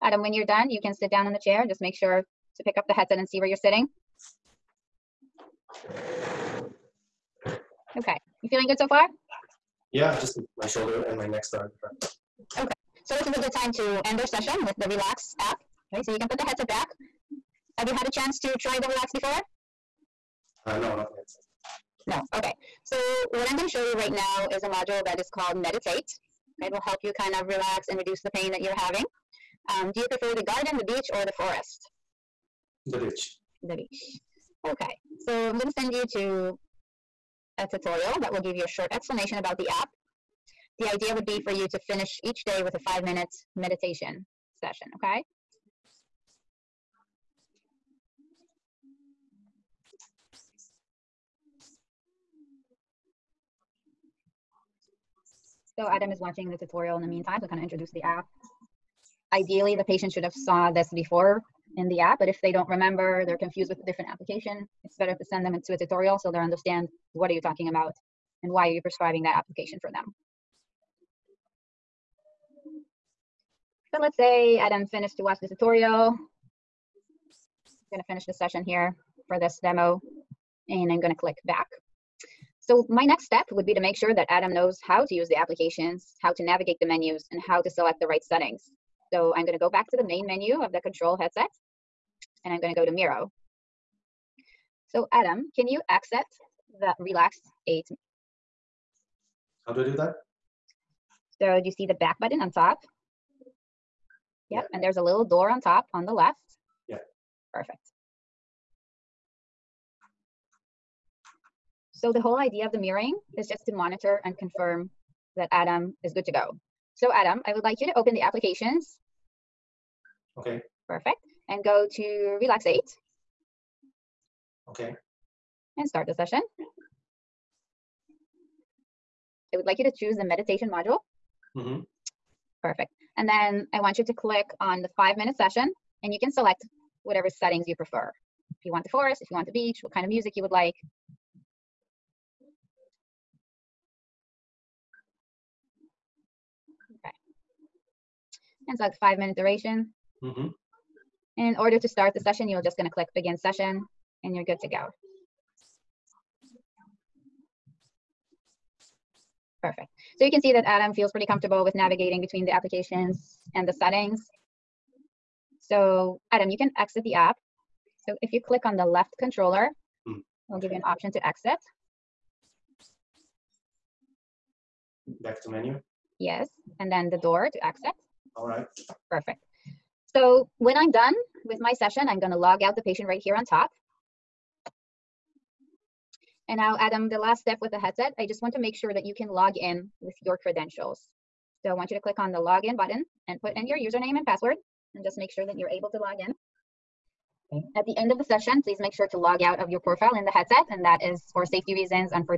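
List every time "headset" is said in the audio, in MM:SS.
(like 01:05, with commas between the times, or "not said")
00:02, 00:16, 01:31, 03:07, 03:20.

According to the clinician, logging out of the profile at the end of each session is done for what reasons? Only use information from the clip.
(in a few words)
Safety reasons.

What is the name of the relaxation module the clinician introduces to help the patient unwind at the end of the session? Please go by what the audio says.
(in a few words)
Meditate.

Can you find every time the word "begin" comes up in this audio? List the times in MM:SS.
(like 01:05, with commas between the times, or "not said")
02:33.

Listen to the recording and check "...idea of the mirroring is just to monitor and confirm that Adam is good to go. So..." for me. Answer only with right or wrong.
right.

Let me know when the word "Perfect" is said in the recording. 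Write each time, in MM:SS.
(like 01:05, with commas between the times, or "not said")
01:47, 02:00, 02:12, 02:39, 02:59.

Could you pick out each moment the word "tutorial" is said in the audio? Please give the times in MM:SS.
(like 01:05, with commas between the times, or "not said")
00:37, 00:56, 01:05, 01:15.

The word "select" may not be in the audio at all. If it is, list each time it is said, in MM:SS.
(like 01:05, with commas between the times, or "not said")
01:27, 02:16.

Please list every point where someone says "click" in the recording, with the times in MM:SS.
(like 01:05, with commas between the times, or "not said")
01:21, 02:14, 02:32, 02:48, 03:11.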